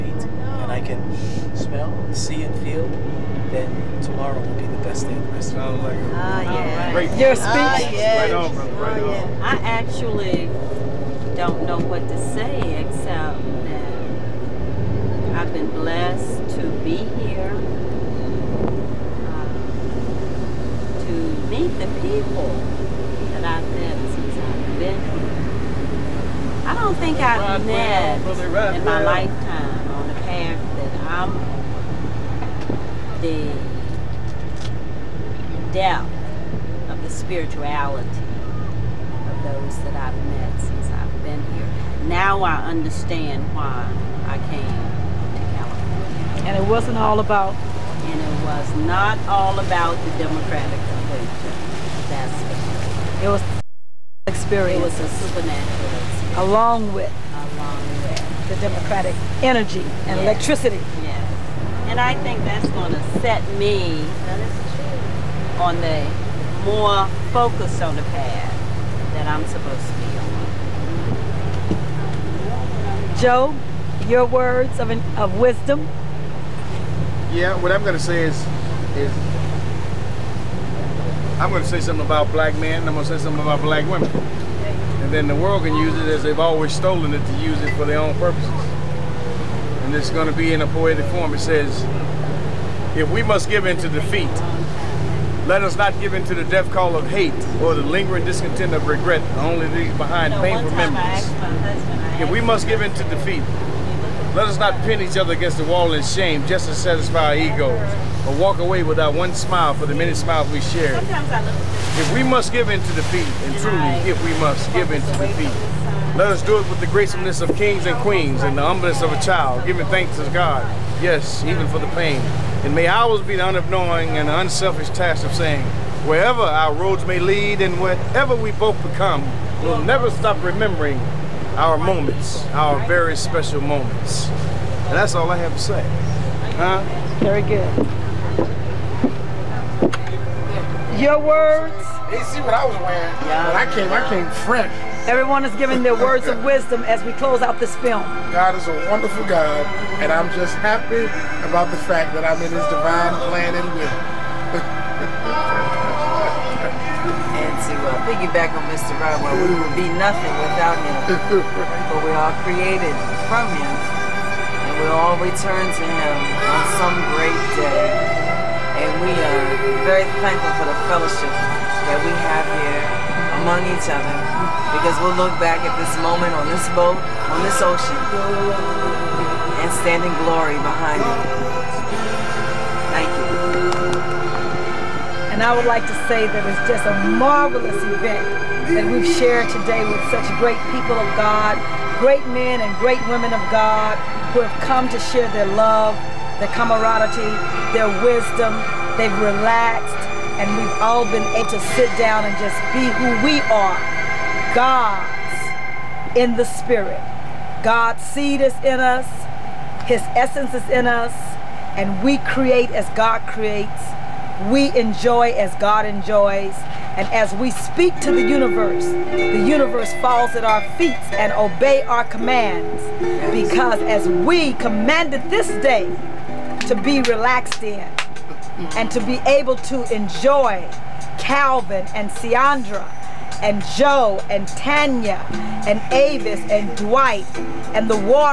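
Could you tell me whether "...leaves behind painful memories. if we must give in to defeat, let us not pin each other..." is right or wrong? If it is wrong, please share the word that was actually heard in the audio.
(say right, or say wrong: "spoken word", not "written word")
right.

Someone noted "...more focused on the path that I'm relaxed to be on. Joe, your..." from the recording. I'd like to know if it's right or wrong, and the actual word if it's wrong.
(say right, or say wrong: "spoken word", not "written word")
wrong: "supposed", not "relaxed".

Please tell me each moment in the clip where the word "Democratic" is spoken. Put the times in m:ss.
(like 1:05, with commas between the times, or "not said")
0:50, 0:58.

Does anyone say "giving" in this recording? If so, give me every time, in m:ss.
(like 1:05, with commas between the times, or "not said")
1:59, 2:25.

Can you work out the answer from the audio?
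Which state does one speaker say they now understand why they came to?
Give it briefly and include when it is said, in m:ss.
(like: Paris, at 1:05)
California, at 0:45.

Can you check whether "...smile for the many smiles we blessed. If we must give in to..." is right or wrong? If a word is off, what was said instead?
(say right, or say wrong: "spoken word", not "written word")
wrong: "shared", not "blessed".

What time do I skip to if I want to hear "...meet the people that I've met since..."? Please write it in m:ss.
0:21.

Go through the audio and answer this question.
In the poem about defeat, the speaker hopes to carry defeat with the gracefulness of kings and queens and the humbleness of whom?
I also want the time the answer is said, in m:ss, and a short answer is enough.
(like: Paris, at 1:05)
a child, at 1:59.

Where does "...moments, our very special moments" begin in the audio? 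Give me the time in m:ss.
2:11.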